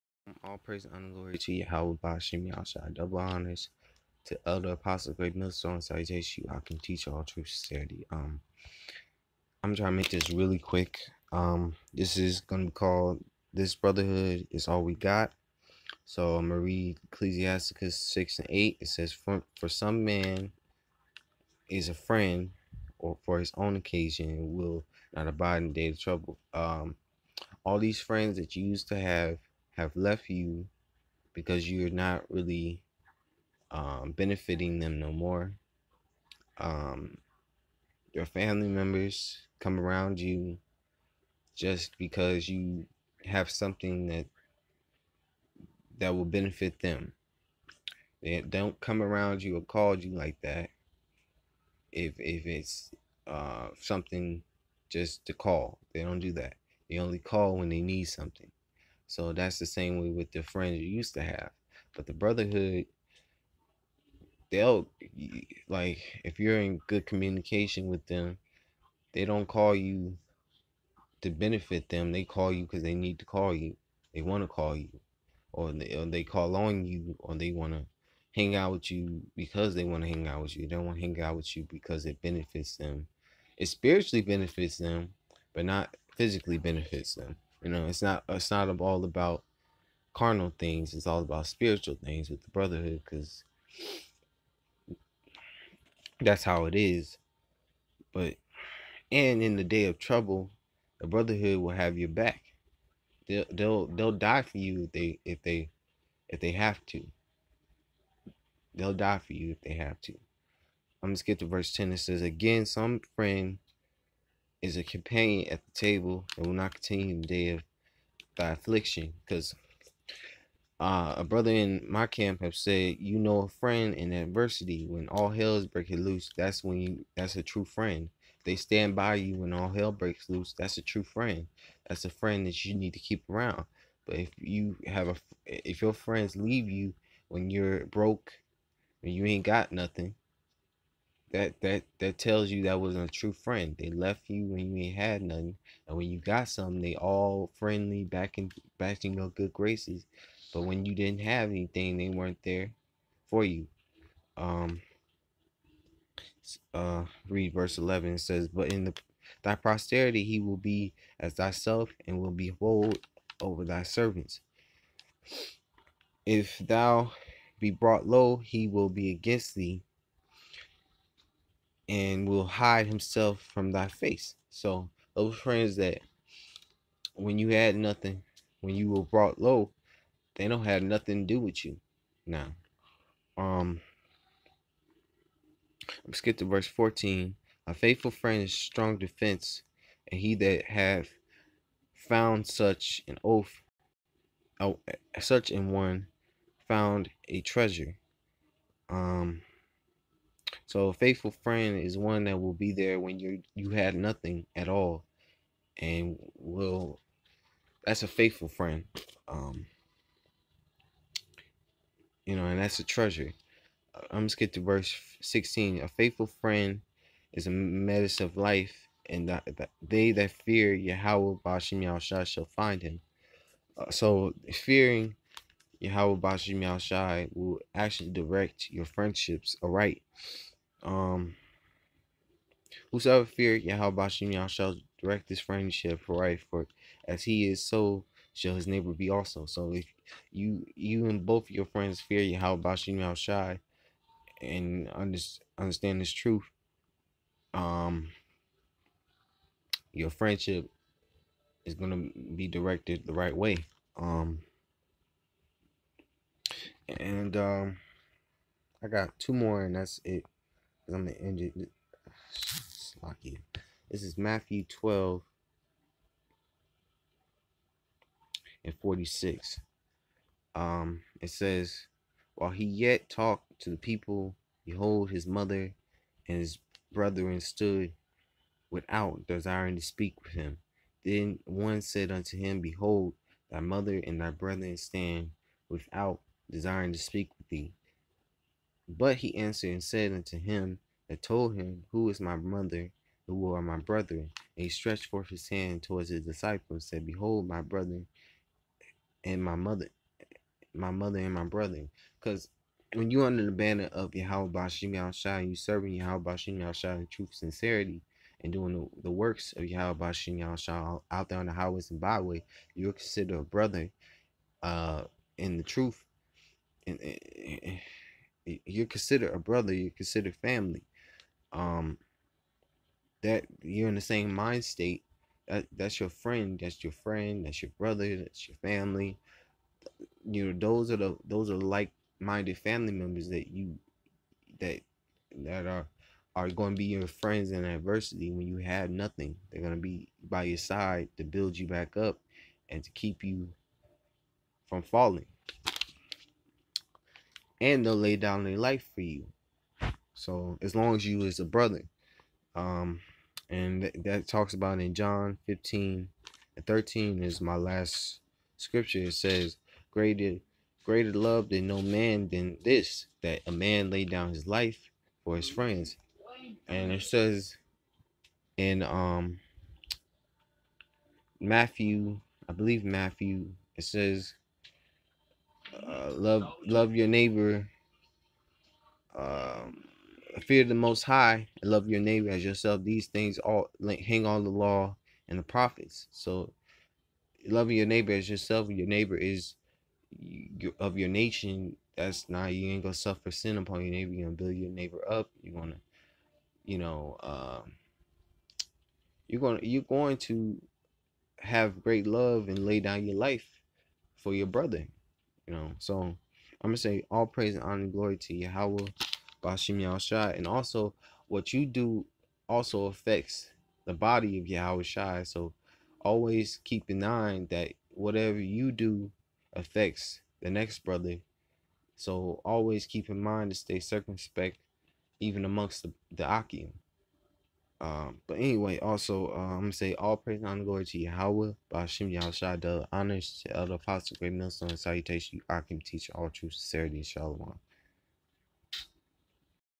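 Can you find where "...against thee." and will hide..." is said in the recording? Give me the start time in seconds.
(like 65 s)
169 s.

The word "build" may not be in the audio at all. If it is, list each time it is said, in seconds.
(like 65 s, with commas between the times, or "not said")
341 s, 394 s.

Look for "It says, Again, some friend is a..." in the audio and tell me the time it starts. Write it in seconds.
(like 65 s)
111 s.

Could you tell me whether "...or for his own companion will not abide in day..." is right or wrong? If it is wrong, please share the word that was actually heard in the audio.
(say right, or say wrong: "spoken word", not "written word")
wrong: "occasion", not "companion".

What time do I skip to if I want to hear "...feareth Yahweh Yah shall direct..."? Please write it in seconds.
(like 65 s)
233 s.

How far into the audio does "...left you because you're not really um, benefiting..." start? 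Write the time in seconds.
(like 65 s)
29 s.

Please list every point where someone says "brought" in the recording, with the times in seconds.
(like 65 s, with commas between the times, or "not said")
167 s, 179 s.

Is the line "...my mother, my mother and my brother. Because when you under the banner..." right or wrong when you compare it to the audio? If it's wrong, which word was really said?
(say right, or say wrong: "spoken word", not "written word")
right.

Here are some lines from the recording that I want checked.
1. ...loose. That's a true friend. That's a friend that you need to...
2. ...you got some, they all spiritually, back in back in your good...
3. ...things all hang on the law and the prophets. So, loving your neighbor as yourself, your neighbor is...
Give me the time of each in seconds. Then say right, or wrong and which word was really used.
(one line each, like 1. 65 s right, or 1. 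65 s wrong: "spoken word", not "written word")
1. 130 s right
2. 146 s wrong: "friendly", not "spiritually"
3. 383 s right.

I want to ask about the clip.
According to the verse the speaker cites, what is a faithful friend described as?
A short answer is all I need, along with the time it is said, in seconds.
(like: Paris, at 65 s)
strong defense, at 188 s.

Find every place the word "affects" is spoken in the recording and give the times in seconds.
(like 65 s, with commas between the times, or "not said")
412 s, 419 s.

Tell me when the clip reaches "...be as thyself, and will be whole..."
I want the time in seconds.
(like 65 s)
160 s.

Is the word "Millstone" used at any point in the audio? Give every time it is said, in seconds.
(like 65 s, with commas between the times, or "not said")
5 s, 434 s.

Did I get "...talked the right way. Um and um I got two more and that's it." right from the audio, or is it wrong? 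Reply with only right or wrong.
wrong.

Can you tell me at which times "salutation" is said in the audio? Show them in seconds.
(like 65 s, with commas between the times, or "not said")
5 s, 434 s.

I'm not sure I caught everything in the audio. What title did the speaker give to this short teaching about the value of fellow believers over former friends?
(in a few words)
This Brotherhood Is All We Got.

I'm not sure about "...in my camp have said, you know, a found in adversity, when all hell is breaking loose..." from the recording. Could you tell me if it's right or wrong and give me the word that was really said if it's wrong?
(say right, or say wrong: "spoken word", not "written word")
wrong: "friend", not "found".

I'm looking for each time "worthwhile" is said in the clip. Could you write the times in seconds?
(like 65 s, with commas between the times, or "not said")
not said.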